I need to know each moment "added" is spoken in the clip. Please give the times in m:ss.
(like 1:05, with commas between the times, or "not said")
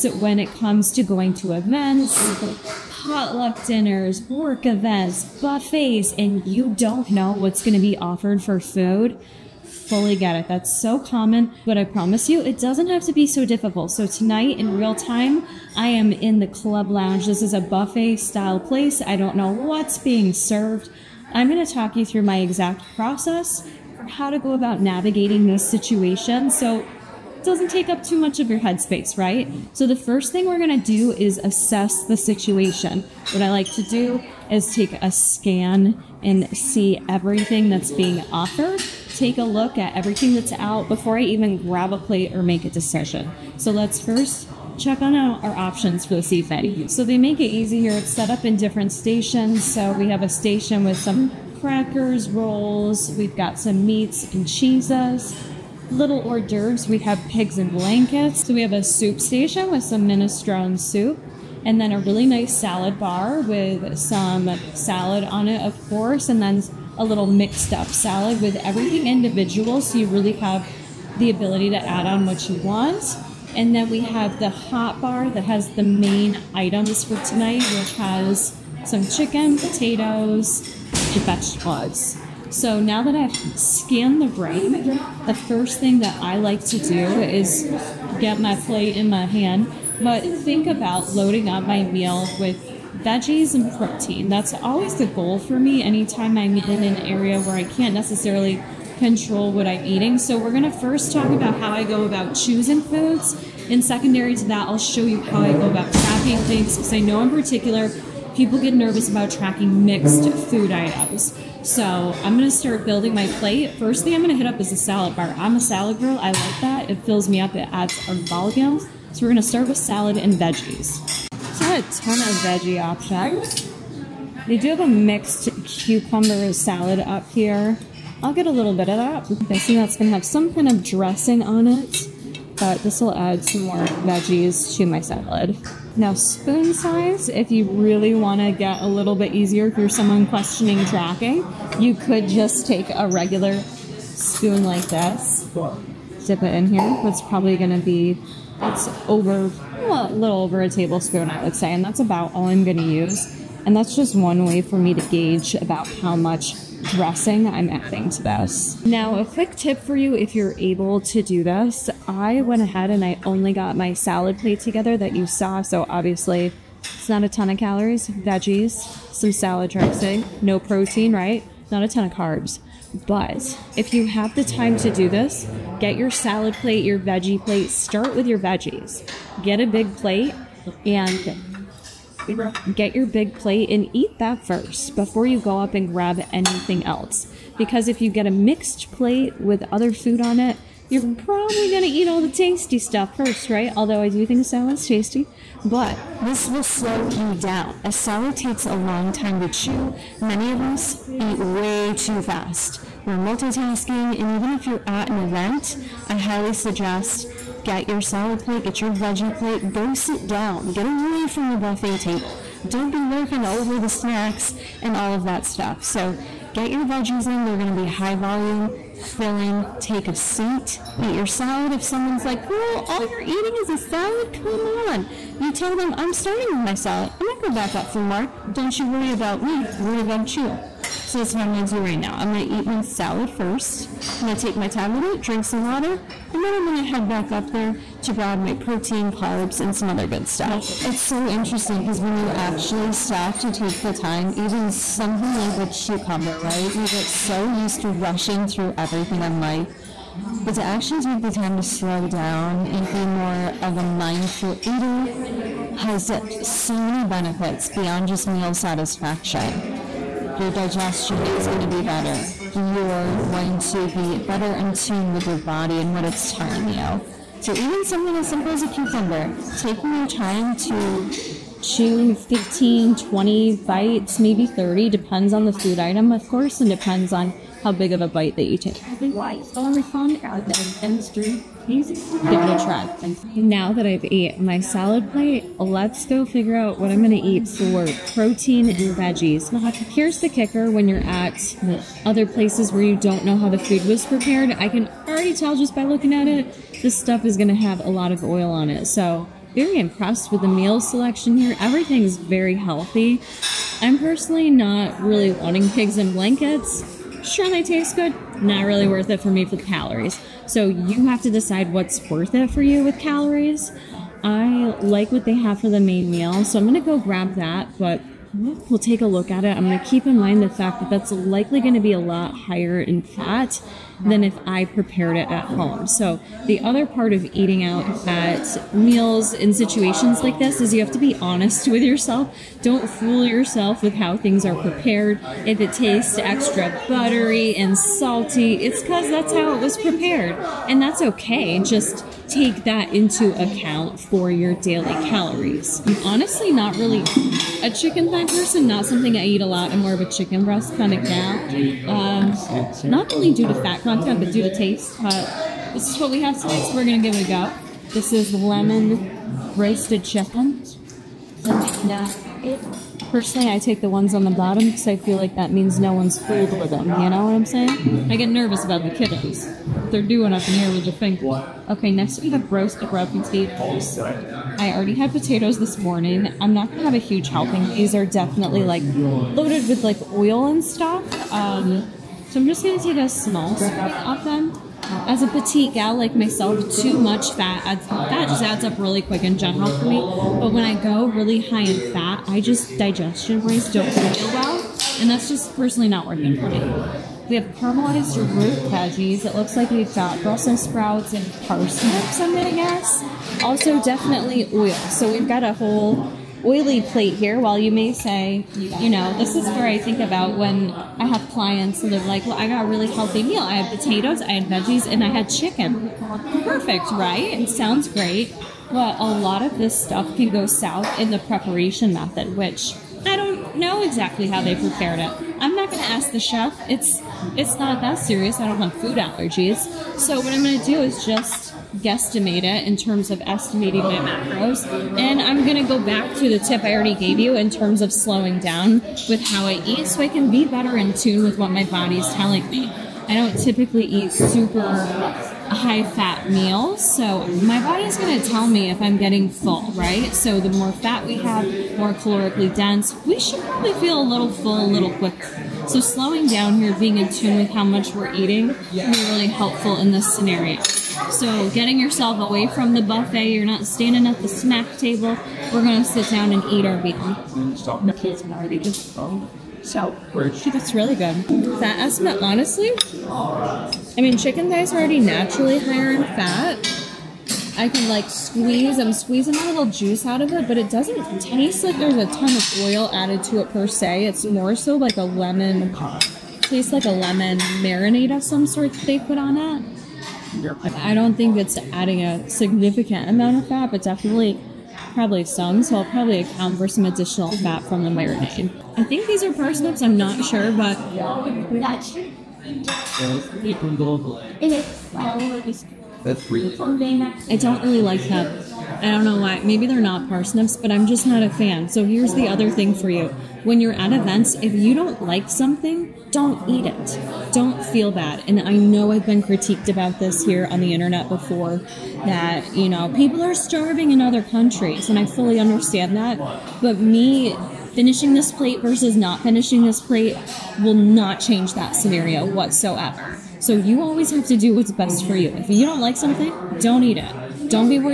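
8:02.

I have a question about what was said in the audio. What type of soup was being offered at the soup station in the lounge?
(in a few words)
Minestrone.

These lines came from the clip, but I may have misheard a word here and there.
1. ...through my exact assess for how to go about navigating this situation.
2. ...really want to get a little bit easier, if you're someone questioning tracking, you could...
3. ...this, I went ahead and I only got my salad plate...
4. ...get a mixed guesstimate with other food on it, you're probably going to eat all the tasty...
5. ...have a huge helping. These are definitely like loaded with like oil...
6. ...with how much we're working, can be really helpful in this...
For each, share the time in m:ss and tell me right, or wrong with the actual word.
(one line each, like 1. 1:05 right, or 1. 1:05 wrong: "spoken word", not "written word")
1. 0:22 wrong: "process", not "assess"
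2. 2:17 right
3. 2:41 right
4. 3:08 wrong: "plate", not "guesstimate"
5. 6:16 right
6. 7:37 wrong: "eating", not "working".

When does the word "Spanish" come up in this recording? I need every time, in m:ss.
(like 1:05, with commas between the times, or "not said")
not said.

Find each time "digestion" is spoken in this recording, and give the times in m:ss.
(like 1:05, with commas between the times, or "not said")
4:20, 6:32.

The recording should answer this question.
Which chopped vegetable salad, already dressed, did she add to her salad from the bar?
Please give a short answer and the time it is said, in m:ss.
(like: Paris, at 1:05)
Cucumber salad, at 2:05.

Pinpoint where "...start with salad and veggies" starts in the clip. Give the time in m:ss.
1:59.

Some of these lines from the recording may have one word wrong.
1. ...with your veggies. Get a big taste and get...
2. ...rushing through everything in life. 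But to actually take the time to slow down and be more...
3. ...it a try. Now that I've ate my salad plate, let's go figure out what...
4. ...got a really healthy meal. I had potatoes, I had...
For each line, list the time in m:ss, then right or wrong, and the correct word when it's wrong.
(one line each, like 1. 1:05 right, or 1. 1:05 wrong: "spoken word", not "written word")
1. 2:58 wrong: "plate", not "taste"
2. 4:07 right
3. 4:39 right
4. 6:52 right.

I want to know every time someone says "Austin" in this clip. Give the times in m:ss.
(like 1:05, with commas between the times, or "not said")
not said.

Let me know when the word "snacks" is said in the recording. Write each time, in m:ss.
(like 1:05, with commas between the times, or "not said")
3:33, 7:44.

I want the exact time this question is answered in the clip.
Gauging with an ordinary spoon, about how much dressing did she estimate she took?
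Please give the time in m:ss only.
2:29.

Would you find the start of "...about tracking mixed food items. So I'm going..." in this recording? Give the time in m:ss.
1:49.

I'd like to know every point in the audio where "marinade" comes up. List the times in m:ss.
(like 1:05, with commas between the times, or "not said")
8:07, 8:17.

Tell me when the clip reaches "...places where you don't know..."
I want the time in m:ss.
4:52.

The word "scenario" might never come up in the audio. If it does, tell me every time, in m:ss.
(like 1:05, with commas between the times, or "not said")
7:40, 8:51.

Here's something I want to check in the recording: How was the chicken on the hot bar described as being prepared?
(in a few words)
Lemon roasted.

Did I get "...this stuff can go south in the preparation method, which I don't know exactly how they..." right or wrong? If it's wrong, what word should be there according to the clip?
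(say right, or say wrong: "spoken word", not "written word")
right.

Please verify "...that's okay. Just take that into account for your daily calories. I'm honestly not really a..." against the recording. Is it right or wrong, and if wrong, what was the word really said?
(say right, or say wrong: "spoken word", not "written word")
right.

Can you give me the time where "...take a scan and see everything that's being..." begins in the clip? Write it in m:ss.
0:34.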